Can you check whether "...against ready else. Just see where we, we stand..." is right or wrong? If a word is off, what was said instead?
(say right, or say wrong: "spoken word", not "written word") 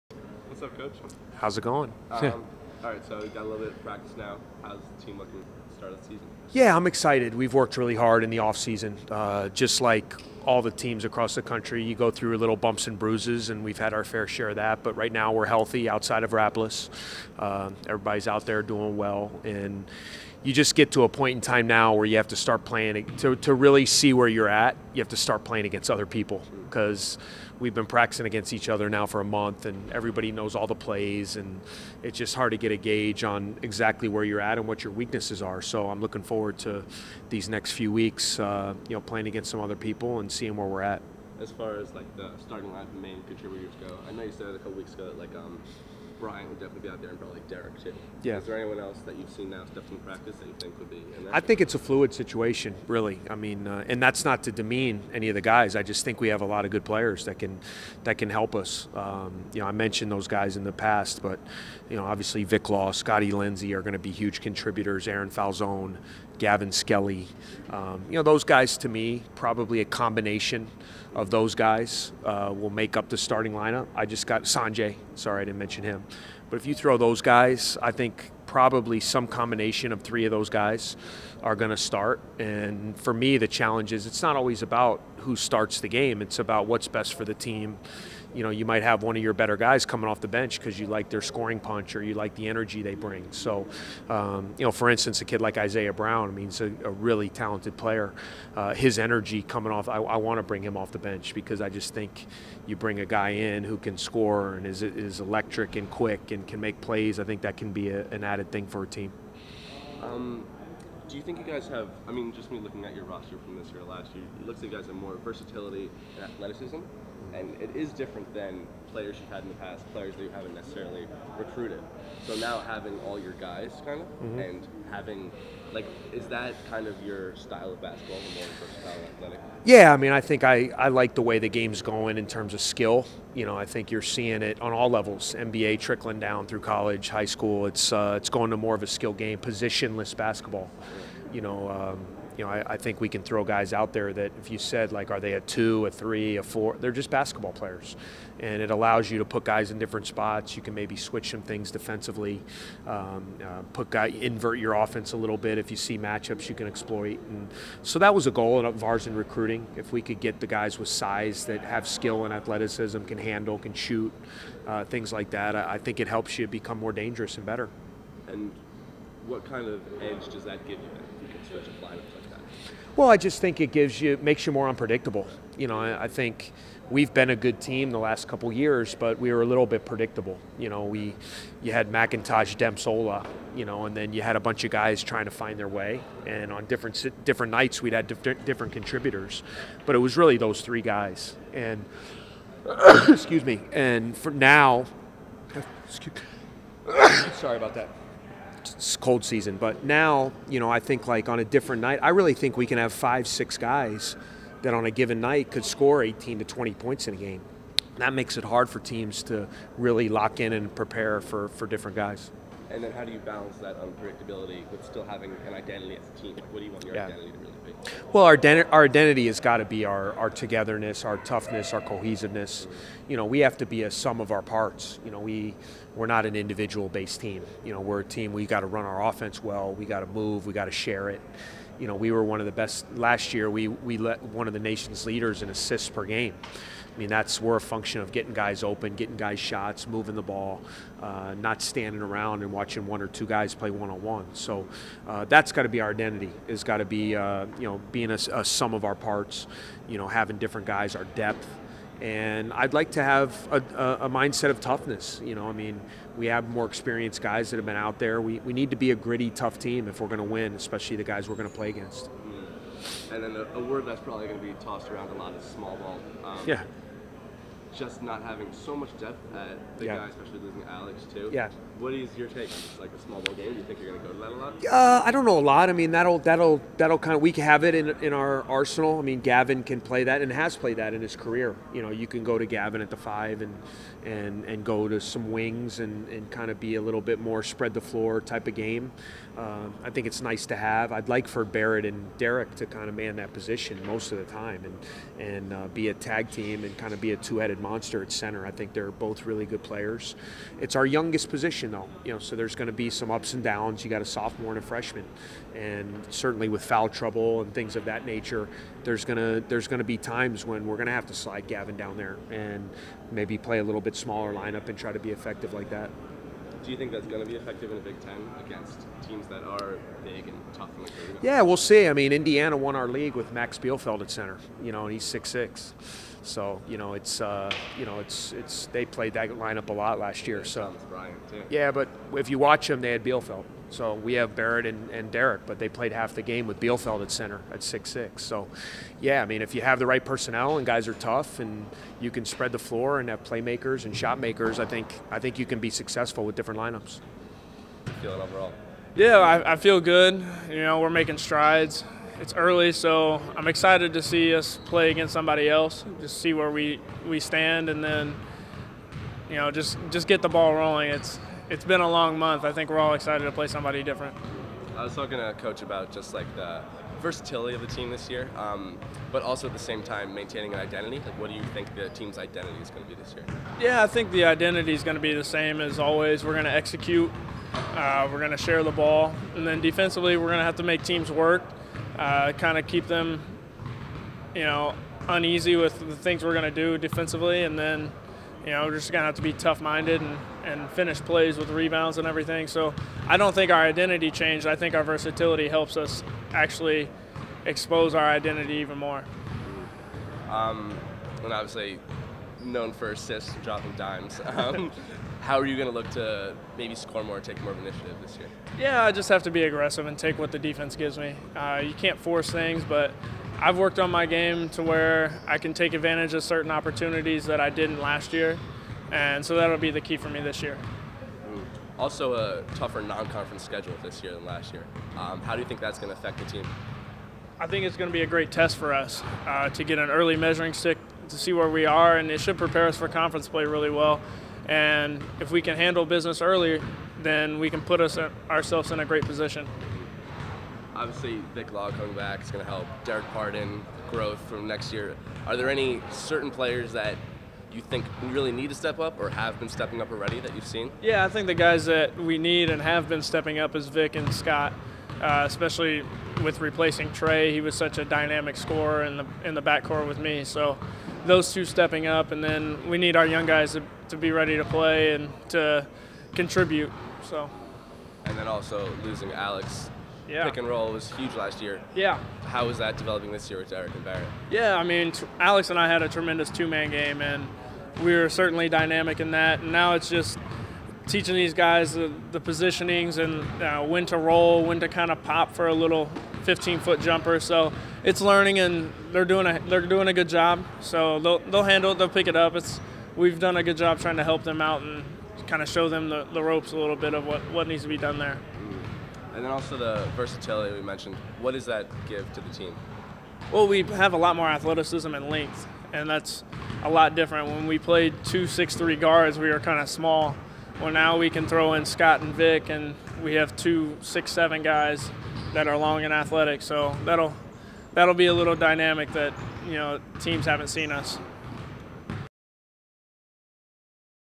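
wrong: "somebody", not "ready".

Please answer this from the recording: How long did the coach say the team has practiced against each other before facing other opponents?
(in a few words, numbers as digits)
a month.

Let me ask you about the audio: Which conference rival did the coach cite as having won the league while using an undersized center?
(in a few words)
Indiana.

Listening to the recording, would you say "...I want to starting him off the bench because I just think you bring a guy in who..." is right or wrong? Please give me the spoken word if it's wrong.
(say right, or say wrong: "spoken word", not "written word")
wrong: "bring", not "starting".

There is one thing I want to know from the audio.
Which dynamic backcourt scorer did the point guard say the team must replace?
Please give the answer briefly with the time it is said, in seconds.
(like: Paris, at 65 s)
Tre, at 456 s.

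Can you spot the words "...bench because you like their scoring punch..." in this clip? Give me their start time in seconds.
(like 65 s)
90 s.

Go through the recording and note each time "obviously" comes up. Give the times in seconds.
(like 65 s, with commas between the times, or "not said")
62 s, 401 s, 440 s.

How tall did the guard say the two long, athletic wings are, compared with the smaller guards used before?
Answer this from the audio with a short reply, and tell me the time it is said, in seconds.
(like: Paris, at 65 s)
6'7", at 513 s.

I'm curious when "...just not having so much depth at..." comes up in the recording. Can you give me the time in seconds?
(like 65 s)
267 s.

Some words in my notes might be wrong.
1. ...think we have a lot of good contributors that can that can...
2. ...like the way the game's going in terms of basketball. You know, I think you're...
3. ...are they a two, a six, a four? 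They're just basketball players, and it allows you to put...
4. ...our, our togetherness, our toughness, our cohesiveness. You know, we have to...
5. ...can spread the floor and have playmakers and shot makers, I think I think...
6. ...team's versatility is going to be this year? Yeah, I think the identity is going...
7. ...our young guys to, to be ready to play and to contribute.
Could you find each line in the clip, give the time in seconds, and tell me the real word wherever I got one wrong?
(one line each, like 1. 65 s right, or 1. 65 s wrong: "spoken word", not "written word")
1. 56 s wrong: "players", not "contributors"
2. 130 s wrong: "skill", not "basketball"
3. 145 s wrong: "three", not "six"
4. 219 s right
5. 342 s right
6. 371 s wrong: "identity", not "versatility"
7. 462 s right.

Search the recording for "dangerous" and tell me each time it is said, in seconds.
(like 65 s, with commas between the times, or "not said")
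166 s.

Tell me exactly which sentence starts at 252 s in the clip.
And I'd like to have a, a, mindset of toughness.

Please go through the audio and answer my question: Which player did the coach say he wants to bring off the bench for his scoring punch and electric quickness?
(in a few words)
Isiah Brown.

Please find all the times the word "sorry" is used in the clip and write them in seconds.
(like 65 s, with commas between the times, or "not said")
75 s, 197 s.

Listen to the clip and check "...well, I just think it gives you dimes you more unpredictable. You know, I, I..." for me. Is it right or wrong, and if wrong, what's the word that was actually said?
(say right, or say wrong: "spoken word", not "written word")
wrong: "makes", not "dimes".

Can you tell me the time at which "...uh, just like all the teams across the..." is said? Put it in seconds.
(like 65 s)
9 s.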